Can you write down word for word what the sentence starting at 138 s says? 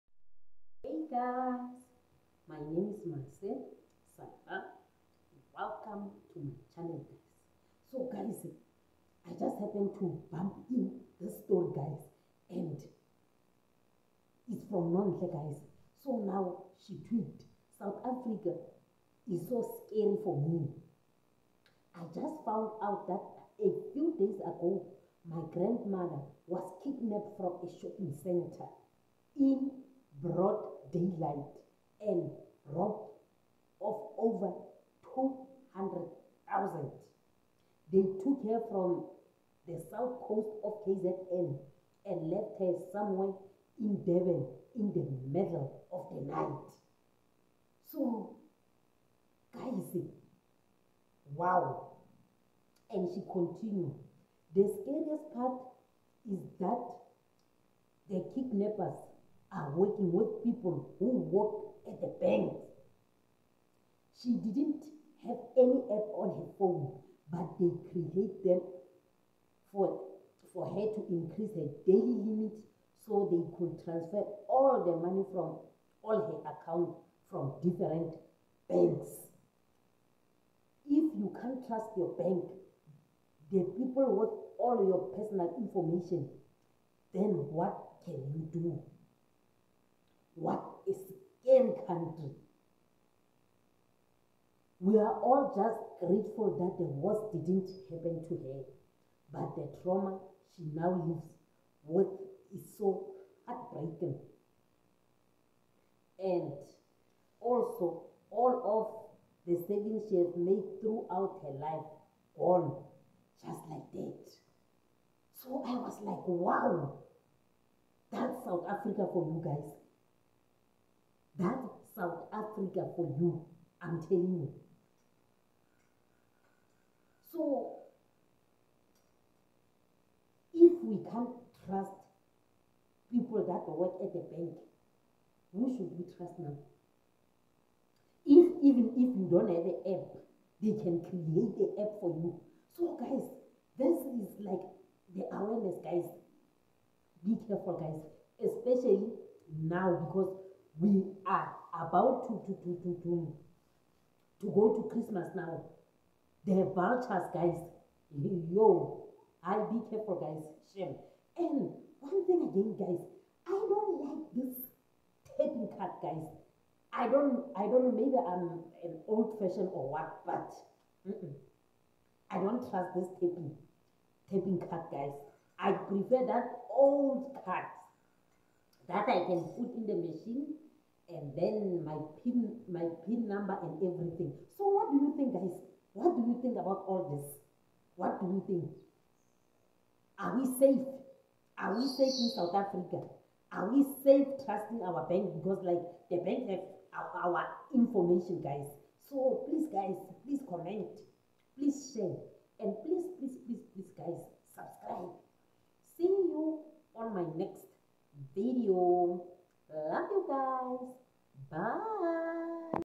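If even if you don't have an app, they can create the app for you.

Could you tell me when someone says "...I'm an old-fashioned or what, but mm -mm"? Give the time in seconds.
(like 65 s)
168 s.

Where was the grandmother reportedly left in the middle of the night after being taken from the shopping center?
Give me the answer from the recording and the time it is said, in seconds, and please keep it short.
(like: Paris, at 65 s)
Devon, at 44 s.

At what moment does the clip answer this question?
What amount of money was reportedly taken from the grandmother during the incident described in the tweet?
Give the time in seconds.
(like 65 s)
34 s.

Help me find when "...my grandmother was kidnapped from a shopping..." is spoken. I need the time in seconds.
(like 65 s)
25 s.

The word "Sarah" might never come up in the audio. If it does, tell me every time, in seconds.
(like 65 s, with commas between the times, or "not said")
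4 s.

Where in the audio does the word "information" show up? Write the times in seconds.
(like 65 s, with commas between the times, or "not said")
85 s, 197 s.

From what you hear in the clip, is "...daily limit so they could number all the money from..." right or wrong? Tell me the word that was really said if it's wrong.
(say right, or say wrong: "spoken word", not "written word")
wrong: "transfer", not "number".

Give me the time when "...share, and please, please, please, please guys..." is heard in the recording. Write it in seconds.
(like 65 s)
201 s.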